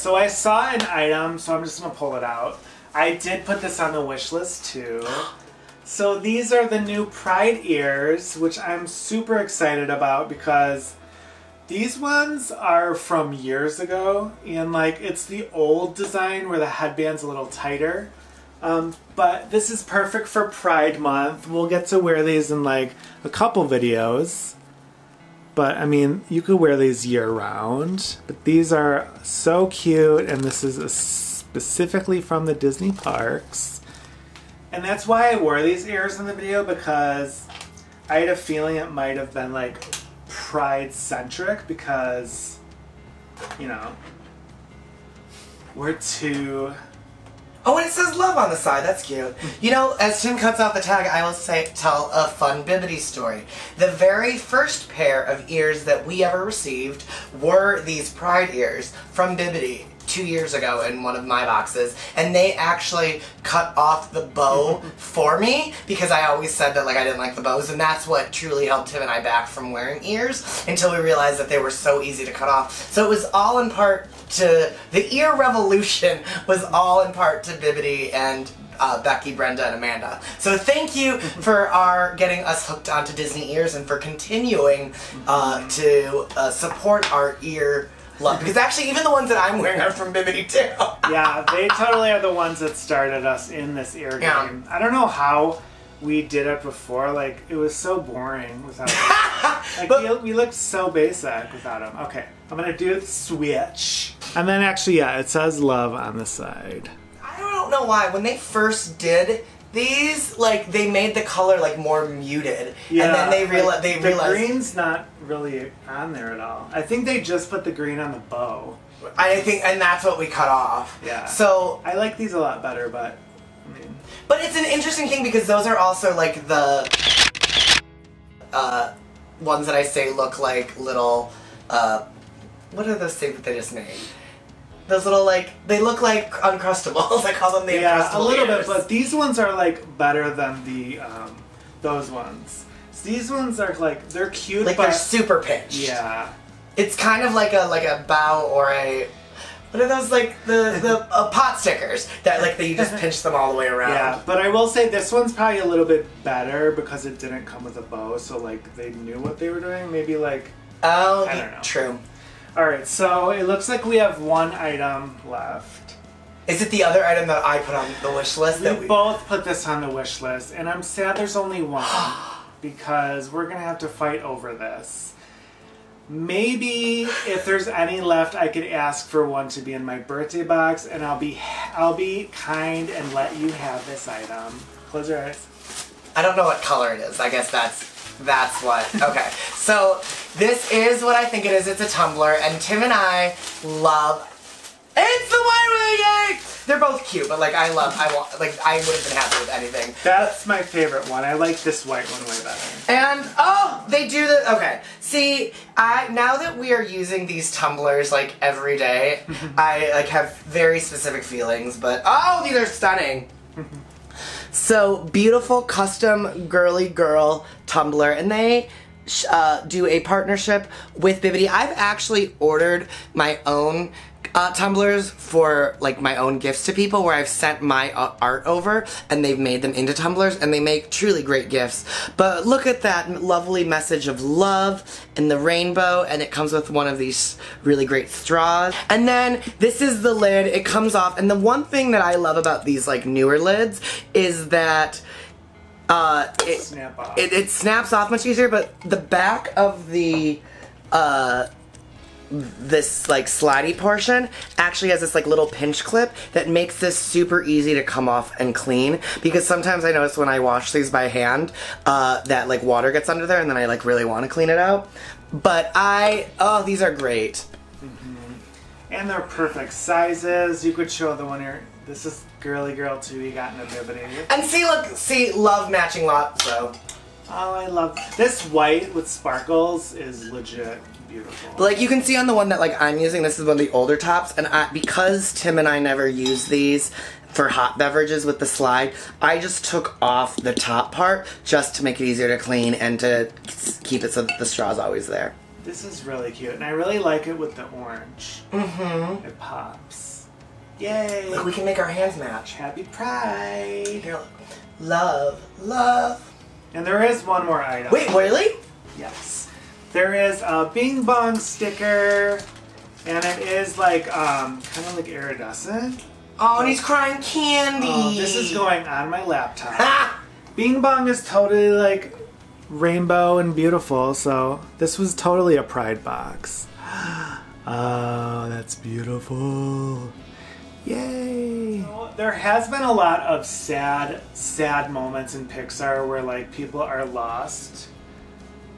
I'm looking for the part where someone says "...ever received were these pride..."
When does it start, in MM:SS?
00:56.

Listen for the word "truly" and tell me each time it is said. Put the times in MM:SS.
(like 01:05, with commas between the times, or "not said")
01:08, 03:50.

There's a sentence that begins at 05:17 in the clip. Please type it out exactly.
Oh, this is going on my laptop.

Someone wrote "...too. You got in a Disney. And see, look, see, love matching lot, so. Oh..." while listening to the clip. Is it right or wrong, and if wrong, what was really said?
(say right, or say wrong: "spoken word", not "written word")
wrong: "Bibbidi", not "Disney".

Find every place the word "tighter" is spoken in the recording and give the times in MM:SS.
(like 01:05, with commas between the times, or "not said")
00:17.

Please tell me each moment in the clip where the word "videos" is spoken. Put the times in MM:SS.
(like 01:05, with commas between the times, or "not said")
00:23, 00:36.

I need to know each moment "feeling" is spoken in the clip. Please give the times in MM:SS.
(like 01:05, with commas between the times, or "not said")
00:38, 03:31.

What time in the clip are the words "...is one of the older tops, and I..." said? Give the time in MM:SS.
04:43.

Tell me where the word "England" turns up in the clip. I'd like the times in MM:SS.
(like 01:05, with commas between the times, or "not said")
not said.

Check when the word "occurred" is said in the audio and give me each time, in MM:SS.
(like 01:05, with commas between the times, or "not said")
not said.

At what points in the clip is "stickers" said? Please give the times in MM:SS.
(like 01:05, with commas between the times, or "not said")
02:31, 05:11.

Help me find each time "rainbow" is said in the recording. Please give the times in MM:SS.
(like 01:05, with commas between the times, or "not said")
03:55, 05:22.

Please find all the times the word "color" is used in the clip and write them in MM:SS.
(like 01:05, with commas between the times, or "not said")
01:51, 03:06.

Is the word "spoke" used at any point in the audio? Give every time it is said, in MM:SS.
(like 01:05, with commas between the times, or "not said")
not said.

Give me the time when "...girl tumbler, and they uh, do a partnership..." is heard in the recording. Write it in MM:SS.
03:36.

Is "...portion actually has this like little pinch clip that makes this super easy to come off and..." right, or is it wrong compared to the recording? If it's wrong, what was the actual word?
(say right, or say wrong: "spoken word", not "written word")
right.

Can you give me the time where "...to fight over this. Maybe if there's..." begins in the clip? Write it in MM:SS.
02:53.